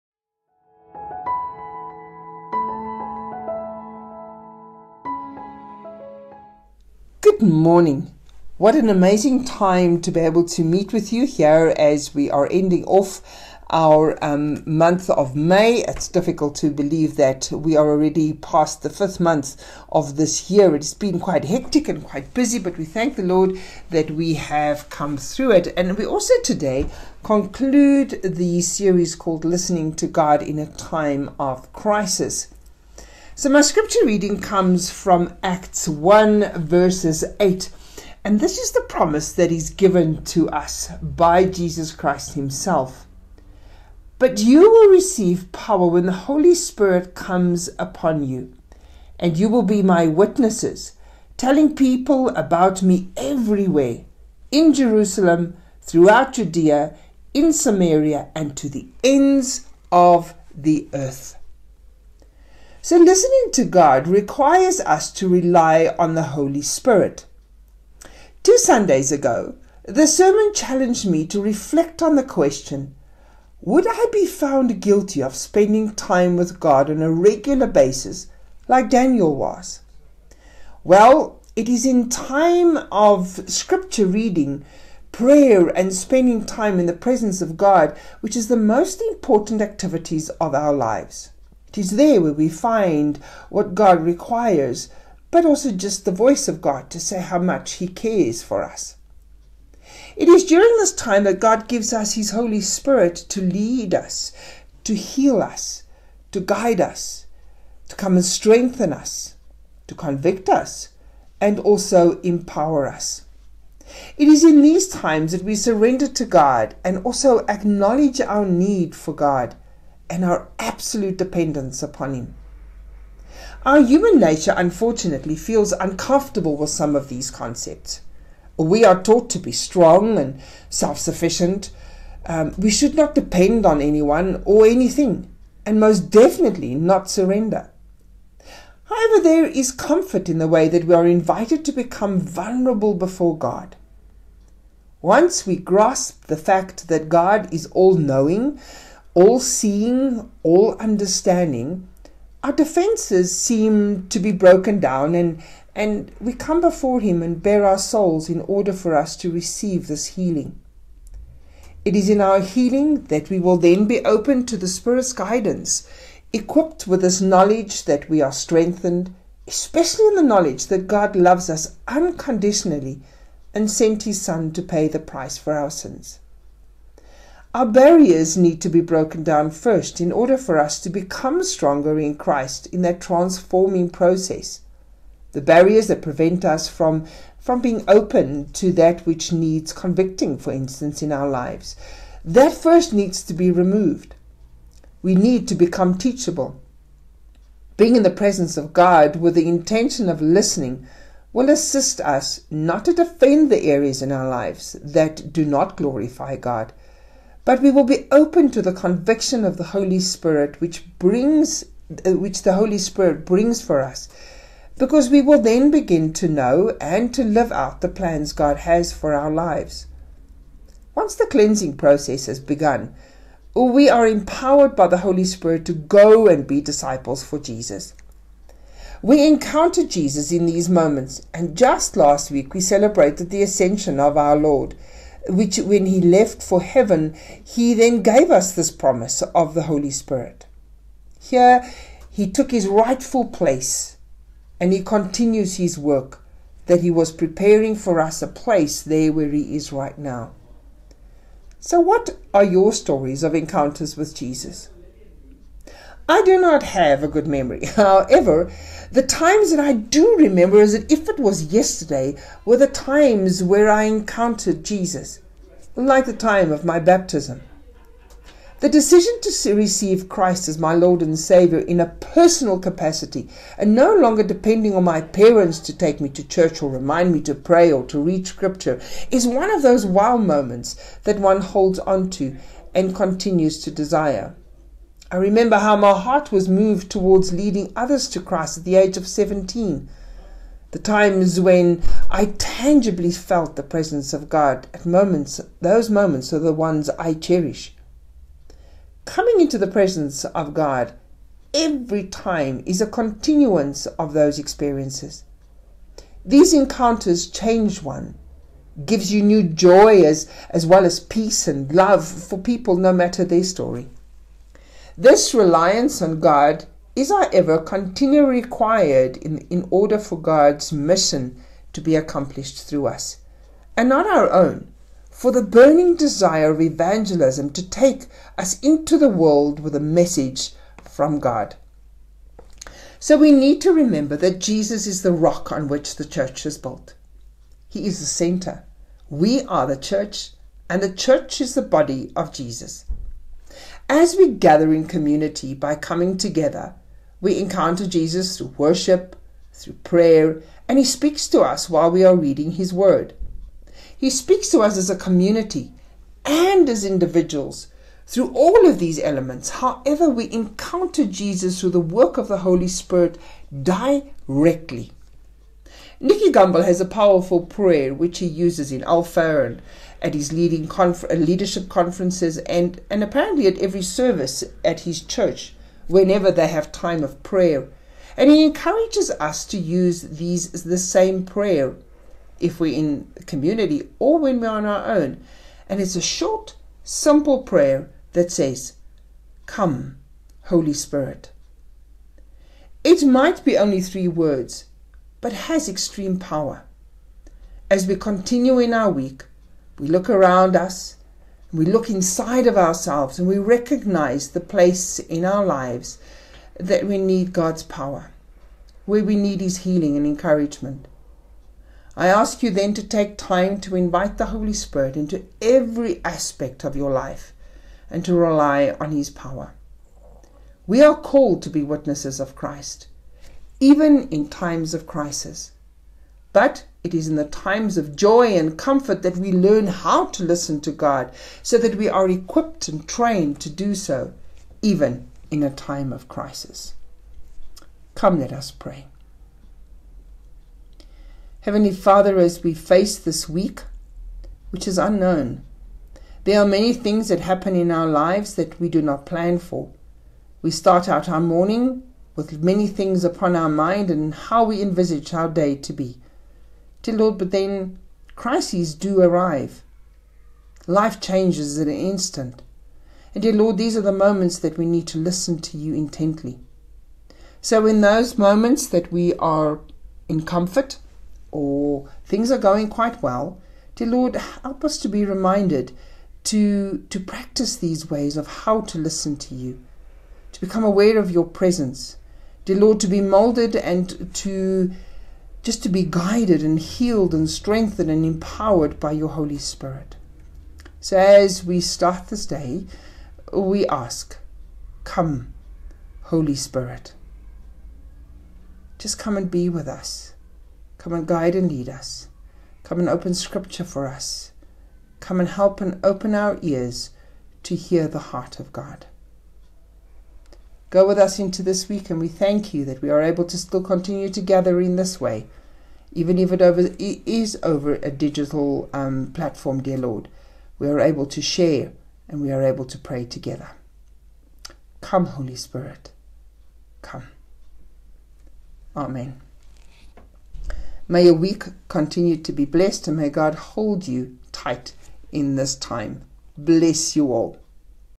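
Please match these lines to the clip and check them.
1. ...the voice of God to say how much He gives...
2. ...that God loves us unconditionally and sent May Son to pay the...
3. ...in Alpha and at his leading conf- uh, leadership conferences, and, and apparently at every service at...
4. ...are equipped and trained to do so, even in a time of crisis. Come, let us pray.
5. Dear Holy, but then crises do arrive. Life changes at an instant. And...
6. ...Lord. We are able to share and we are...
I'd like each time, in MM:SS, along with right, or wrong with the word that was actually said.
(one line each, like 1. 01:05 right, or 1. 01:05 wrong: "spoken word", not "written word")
1. 01:36 wrong: "cares", not "gives"
2. 02:50 wrong: "His", not "May"
3. 06:08 right
4. 07:11 right
5. 07:36 wrong: "Lord", not "Holy"
6. 08:39 right.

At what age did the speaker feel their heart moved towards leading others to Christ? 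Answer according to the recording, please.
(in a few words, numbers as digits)
17.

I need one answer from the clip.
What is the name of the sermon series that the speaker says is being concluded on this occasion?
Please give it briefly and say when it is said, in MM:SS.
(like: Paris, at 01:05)
Listening to God in a Time of Crisis, at 00:29.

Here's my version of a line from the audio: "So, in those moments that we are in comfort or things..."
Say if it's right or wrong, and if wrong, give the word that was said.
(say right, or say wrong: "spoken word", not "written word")
right.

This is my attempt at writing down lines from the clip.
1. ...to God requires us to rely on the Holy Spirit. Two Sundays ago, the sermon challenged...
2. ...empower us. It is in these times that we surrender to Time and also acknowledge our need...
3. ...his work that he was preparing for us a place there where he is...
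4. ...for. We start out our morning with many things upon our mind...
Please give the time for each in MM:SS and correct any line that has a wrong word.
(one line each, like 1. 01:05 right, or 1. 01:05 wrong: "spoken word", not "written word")
1. 01:03 right
2. 01:52 wrong: "God", not "Time"
3. 04:05 right
4. 07:29 right.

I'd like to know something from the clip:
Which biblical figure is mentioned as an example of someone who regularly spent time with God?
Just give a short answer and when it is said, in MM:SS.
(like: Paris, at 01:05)
Daniel, at 01:18.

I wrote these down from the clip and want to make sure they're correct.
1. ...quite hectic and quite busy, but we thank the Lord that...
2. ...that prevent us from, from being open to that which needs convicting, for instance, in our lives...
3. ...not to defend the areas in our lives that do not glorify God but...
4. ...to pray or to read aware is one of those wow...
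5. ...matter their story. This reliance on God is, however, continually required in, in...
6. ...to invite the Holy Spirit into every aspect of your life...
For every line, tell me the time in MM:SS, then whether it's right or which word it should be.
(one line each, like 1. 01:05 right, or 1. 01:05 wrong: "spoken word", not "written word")
1. 00:21 right
2. 03:05 right
3. 03:22 right
4. 04:37 wrong: "scripture", not "aware"
5. 05:12 right
6. 06:53 right.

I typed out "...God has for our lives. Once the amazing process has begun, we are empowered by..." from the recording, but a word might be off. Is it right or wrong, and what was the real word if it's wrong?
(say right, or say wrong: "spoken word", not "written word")
wrong: "cleansing", not "amazing".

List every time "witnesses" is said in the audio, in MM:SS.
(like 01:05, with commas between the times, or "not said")
00:50, 07:01.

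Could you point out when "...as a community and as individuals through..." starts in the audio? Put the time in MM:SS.
05:54.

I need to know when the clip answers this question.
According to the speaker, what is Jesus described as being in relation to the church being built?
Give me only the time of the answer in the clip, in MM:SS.
05:35.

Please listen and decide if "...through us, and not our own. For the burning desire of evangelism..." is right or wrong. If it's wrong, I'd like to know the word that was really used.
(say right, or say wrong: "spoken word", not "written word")
right.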